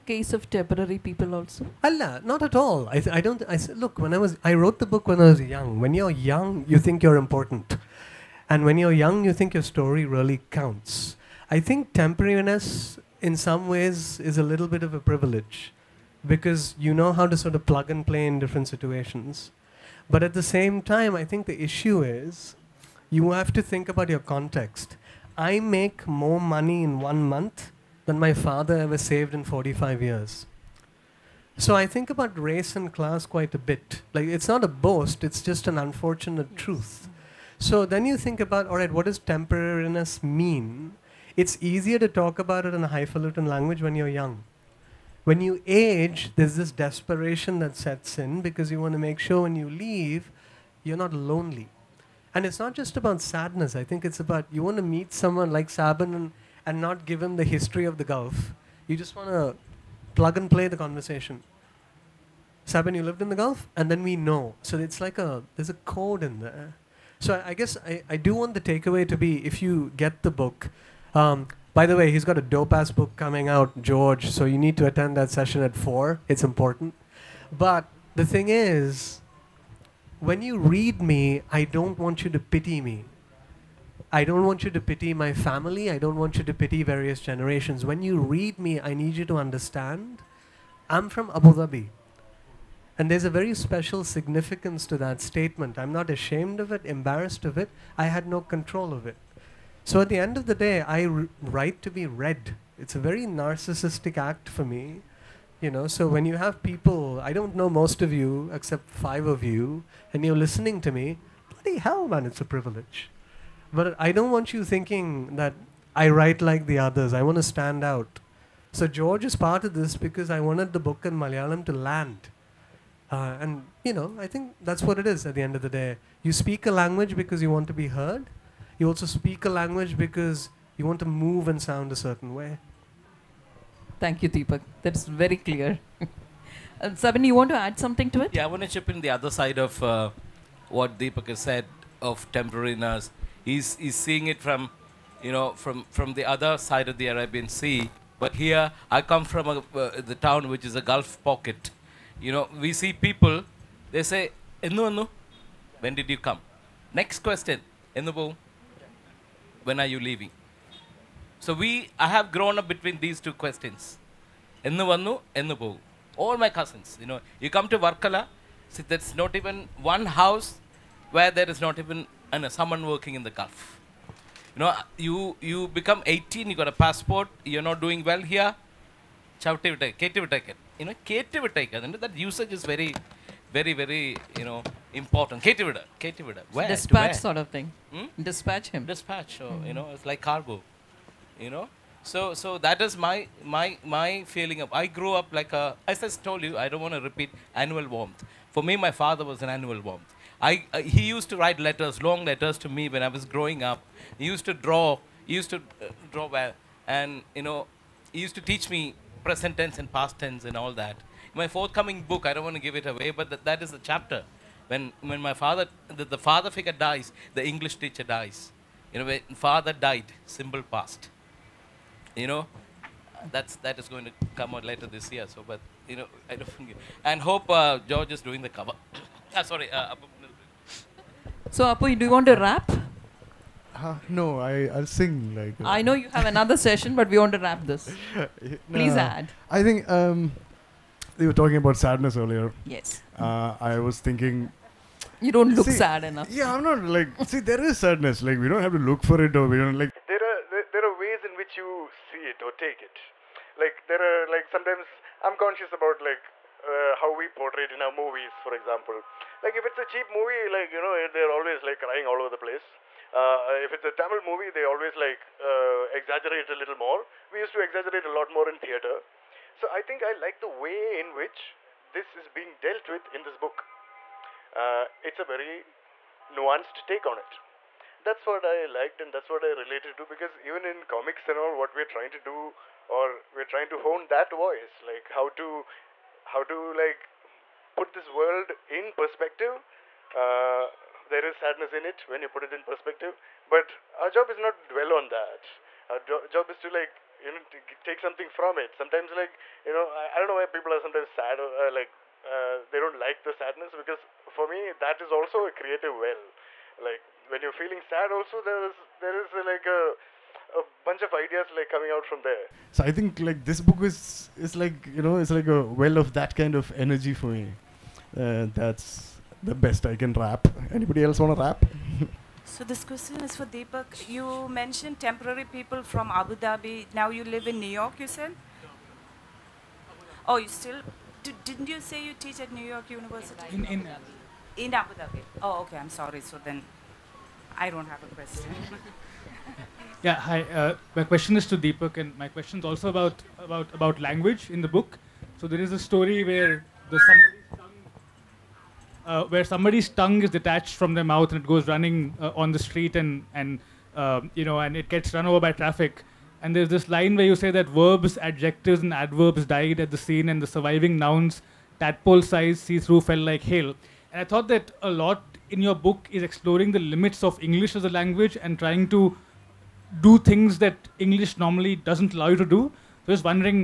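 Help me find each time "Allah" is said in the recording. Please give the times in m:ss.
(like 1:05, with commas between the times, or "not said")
0:01.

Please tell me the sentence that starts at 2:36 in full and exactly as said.
Next question, Ennu, when are you leaving?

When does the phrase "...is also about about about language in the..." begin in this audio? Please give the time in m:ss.
5:42.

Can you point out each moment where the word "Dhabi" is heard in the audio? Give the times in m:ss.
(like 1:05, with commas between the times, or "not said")
1:31, 5:26, 5:34.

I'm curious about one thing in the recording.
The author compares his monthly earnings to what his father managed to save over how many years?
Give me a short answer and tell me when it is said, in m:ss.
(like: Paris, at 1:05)
45, at 0:29.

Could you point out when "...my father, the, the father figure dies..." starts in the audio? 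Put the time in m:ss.
3:35.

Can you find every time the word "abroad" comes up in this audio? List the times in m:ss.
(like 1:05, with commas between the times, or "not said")
not said.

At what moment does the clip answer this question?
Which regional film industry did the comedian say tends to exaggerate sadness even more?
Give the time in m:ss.
4:23.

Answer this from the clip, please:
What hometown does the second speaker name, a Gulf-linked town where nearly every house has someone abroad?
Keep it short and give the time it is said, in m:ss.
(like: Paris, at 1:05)
Varkala, at 2:47.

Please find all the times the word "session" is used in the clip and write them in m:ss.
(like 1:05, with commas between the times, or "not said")
1:15, 3:56.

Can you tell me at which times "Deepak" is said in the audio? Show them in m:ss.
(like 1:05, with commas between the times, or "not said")
2:14, 2:20, 5:23, 5:41.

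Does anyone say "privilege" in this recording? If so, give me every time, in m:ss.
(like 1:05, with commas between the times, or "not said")
0:15, 1:52.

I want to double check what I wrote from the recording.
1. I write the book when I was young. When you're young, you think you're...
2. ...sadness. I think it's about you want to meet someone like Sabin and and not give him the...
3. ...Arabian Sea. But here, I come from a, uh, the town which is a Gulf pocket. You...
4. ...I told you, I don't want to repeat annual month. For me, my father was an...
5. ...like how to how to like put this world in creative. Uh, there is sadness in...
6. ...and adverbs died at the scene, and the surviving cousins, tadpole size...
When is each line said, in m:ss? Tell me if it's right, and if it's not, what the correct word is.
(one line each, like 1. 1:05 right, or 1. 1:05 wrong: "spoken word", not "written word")
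1. 0:04 wrong: "wrote", not "write"
2. 0:53 right
3. 2:27 right
4. 3:16 wrong: "warmth", not "month"
5. 4:44 wrong: "perspective", not "creative"
6. 5:58 wrong: "nouns", not "cousins".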